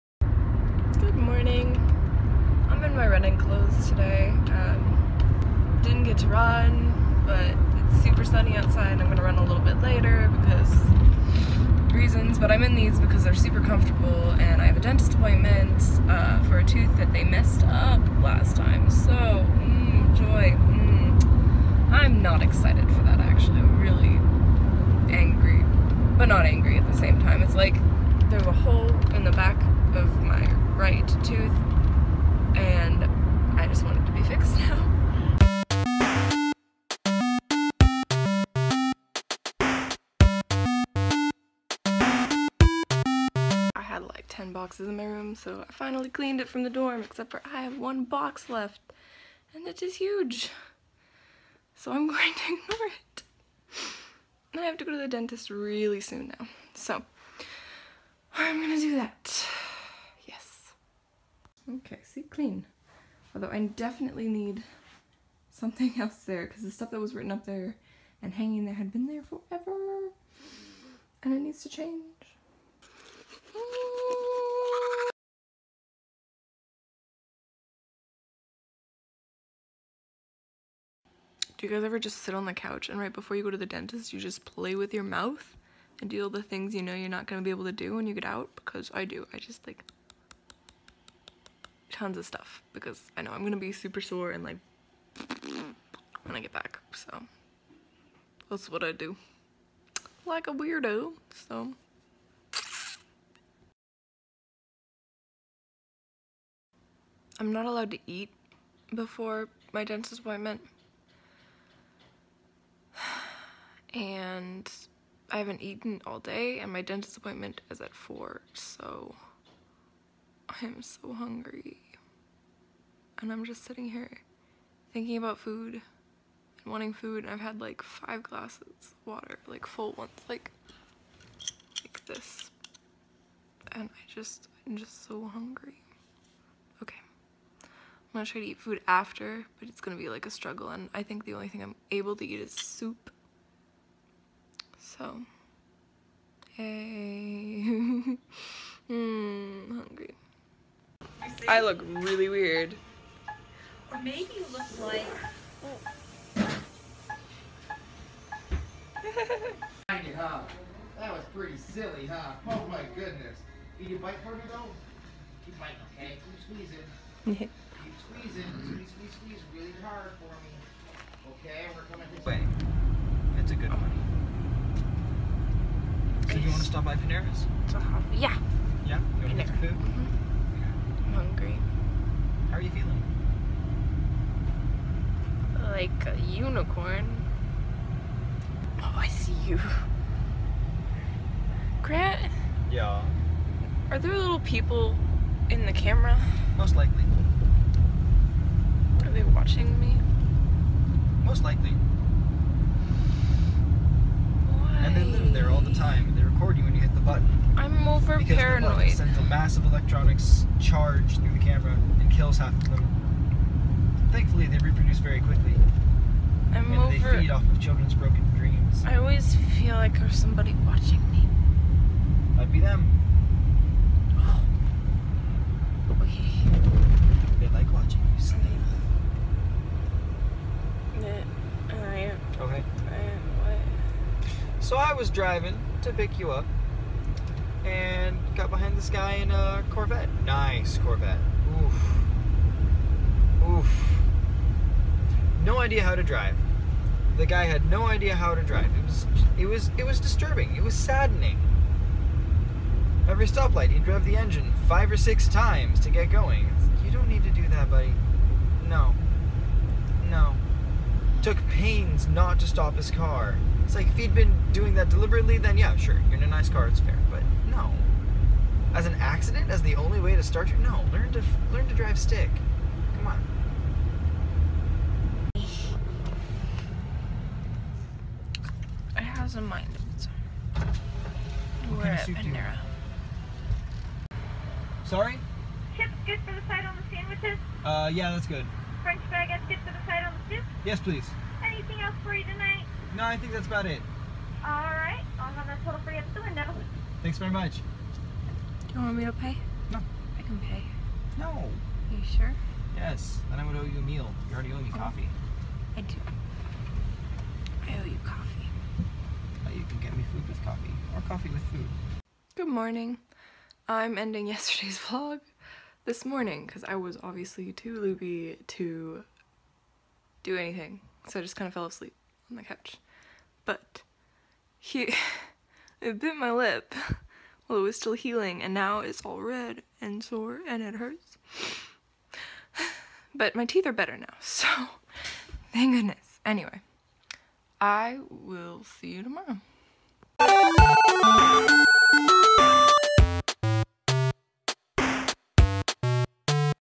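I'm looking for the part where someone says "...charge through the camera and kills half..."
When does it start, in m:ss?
3:30.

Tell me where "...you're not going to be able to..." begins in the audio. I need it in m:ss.
1:26.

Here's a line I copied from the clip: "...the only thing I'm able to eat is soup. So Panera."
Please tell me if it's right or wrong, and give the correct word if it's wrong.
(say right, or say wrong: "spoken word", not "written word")
wrong: "Hey", not "Panera".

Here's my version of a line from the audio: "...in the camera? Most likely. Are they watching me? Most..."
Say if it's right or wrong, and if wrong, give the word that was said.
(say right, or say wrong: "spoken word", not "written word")
right.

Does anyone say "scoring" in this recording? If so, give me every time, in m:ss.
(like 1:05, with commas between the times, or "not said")
not said.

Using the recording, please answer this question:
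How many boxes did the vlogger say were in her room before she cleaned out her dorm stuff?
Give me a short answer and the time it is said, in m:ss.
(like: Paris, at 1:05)
10, at 0:44.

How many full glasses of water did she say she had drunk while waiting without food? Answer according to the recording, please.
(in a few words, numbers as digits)
5.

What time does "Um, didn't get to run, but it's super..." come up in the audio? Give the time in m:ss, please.
0:04.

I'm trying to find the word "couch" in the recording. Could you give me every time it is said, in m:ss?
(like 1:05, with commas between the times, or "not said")
1:22, 5:22.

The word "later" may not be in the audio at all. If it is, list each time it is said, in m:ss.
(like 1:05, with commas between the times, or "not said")
0:09.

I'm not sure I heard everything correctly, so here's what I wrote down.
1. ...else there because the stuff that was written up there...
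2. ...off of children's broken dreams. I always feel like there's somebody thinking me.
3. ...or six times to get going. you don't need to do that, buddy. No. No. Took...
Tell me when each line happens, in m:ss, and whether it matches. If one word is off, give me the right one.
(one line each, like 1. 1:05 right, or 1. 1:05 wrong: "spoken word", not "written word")
1. 1:05 right
2. 3:37 wrong: "watching", not "thinking"
3. 4:14 right.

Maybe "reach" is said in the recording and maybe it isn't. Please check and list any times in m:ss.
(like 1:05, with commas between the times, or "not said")
not said.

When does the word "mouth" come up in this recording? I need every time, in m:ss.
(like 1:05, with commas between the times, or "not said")
1:25.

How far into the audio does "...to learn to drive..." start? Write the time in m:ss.
4:31.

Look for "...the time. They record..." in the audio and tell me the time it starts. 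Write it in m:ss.
3:25.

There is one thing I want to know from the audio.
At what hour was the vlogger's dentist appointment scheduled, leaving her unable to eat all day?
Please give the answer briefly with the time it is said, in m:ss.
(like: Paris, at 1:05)
4, at 1:57.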